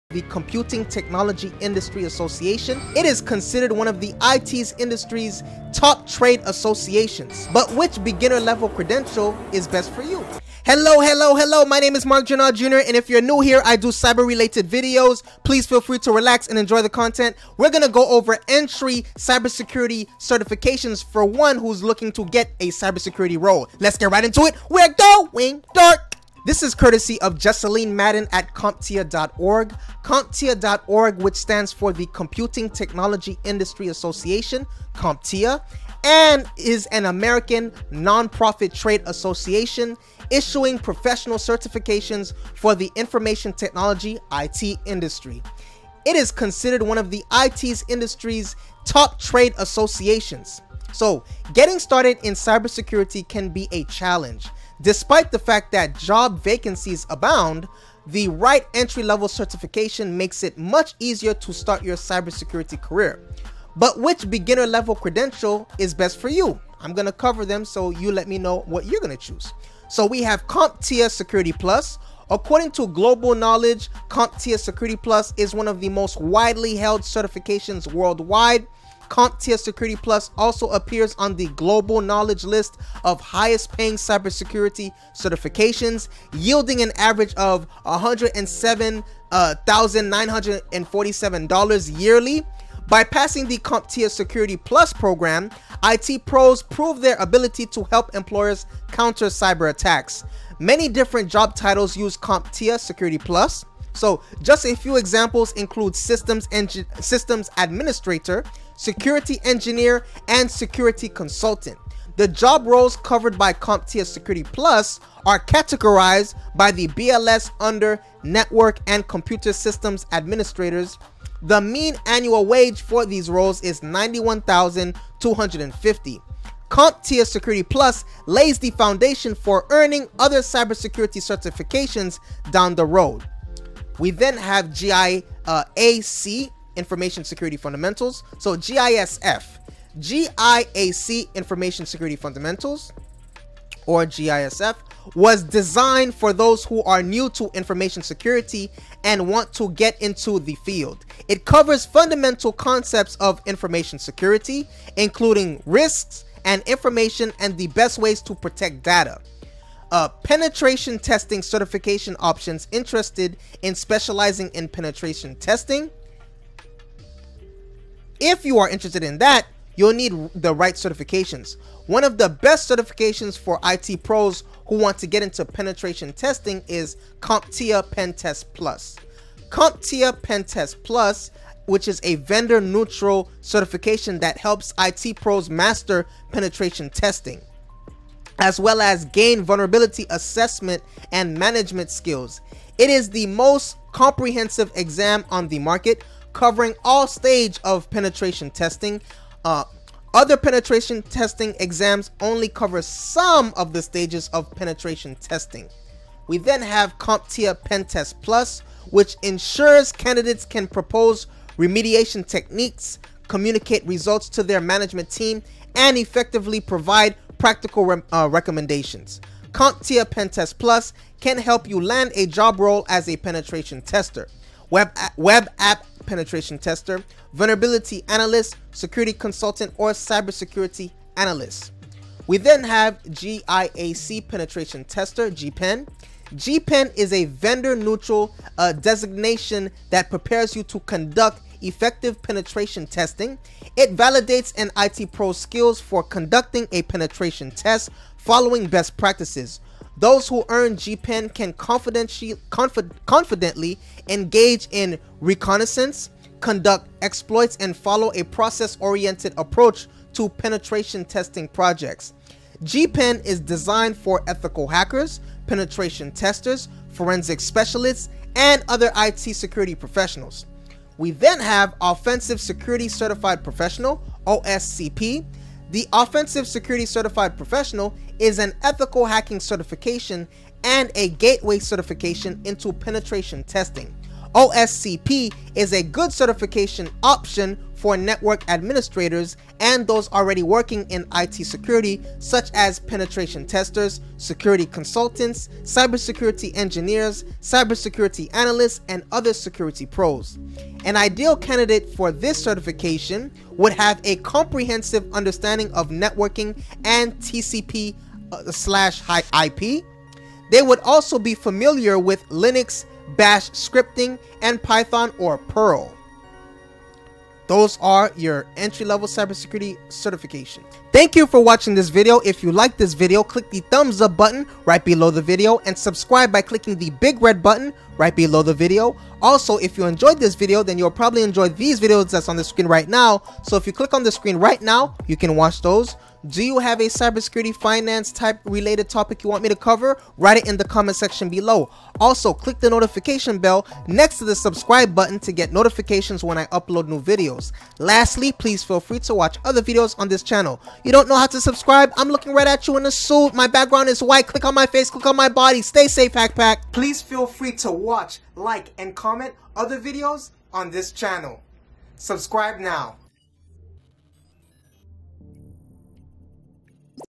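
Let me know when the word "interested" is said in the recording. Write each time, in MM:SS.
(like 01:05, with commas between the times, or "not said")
02:42, 02:48.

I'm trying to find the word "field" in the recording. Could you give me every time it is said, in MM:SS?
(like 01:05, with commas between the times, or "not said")
02:30.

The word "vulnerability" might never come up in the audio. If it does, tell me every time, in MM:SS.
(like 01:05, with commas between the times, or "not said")
03:09, 03:47.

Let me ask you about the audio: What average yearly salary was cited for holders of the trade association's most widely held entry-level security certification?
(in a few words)
$107,947.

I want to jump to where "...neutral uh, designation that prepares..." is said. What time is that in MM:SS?
03:57.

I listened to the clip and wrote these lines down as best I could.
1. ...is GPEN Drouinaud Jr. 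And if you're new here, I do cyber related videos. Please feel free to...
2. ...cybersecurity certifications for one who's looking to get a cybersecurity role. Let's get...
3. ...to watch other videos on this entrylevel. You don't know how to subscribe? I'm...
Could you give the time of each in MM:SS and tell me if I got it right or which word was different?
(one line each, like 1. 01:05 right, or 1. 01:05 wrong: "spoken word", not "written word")
1. 00:11 wrong: "Marc", not "GPEN"
2. 00:19 right
3. 05:48 wrong: "channel", not "entrylevel".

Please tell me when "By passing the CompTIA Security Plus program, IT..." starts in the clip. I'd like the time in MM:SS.
01:32.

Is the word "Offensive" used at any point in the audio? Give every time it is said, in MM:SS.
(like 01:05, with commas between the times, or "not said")
04:31, 04:35.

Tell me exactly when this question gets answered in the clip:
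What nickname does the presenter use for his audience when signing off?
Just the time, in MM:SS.
05:56.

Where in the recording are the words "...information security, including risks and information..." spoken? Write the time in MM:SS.
02:33.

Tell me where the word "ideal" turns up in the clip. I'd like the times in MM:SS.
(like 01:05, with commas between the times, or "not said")
05:00.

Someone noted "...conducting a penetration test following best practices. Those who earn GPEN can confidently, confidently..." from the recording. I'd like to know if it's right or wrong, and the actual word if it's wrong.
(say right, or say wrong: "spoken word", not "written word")
right.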